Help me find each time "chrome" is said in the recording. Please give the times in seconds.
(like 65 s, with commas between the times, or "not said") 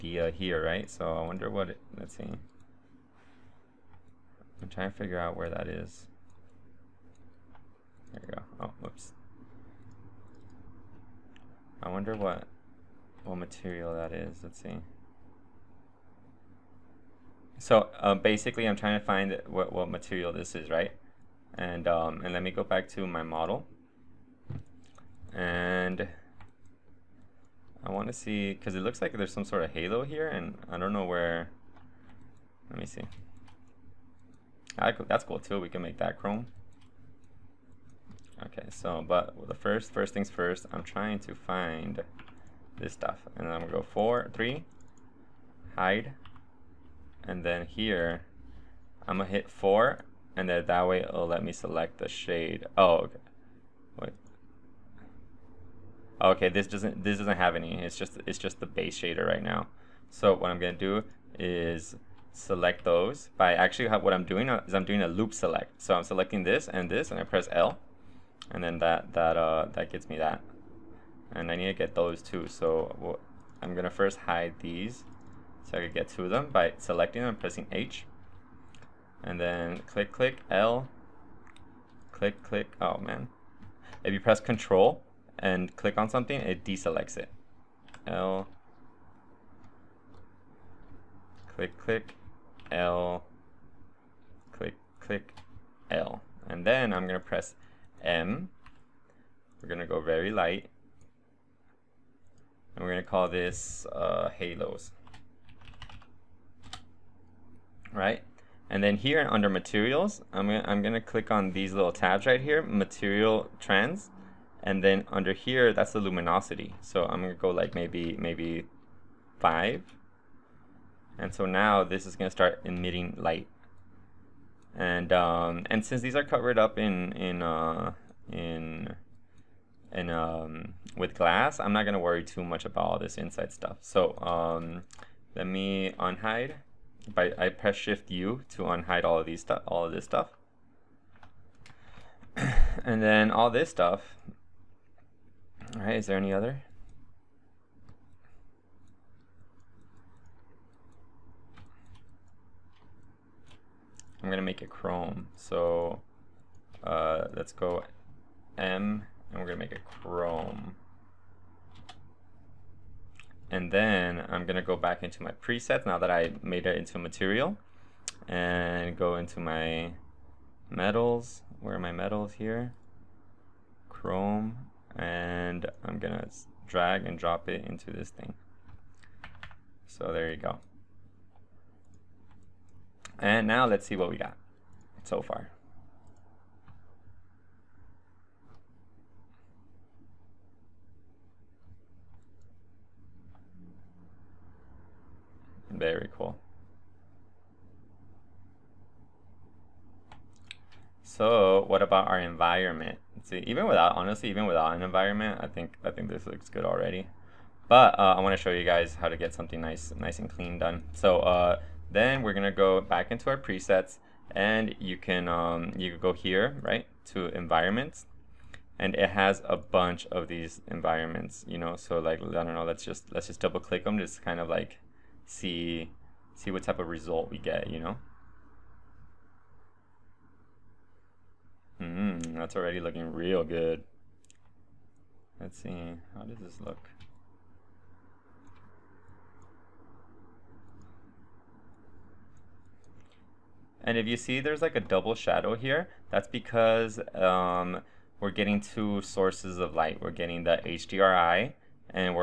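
36 s, 154 s, 159 s, 173 s.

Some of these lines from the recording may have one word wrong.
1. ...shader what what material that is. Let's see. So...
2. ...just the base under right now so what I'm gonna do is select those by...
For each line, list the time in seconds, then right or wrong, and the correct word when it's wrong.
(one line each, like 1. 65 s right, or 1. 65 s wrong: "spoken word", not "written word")
1. 11 s wrong: "wonder", not "shader"
2. 58 s wrong: "shader", not "under".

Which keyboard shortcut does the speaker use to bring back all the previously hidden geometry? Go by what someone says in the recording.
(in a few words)
Shift U.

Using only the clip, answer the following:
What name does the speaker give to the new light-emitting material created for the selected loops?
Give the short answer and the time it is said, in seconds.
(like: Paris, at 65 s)
halos, at 104 s.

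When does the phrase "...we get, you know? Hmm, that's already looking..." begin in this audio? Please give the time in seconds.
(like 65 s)
227 s.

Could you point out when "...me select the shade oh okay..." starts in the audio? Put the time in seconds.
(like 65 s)
51 s.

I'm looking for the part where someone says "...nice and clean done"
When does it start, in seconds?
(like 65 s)
209 s.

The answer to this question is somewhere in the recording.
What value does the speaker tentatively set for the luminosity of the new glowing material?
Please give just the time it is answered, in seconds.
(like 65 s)
119 s.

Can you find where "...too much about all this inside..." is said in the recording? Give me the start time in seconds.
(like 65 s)
132 s.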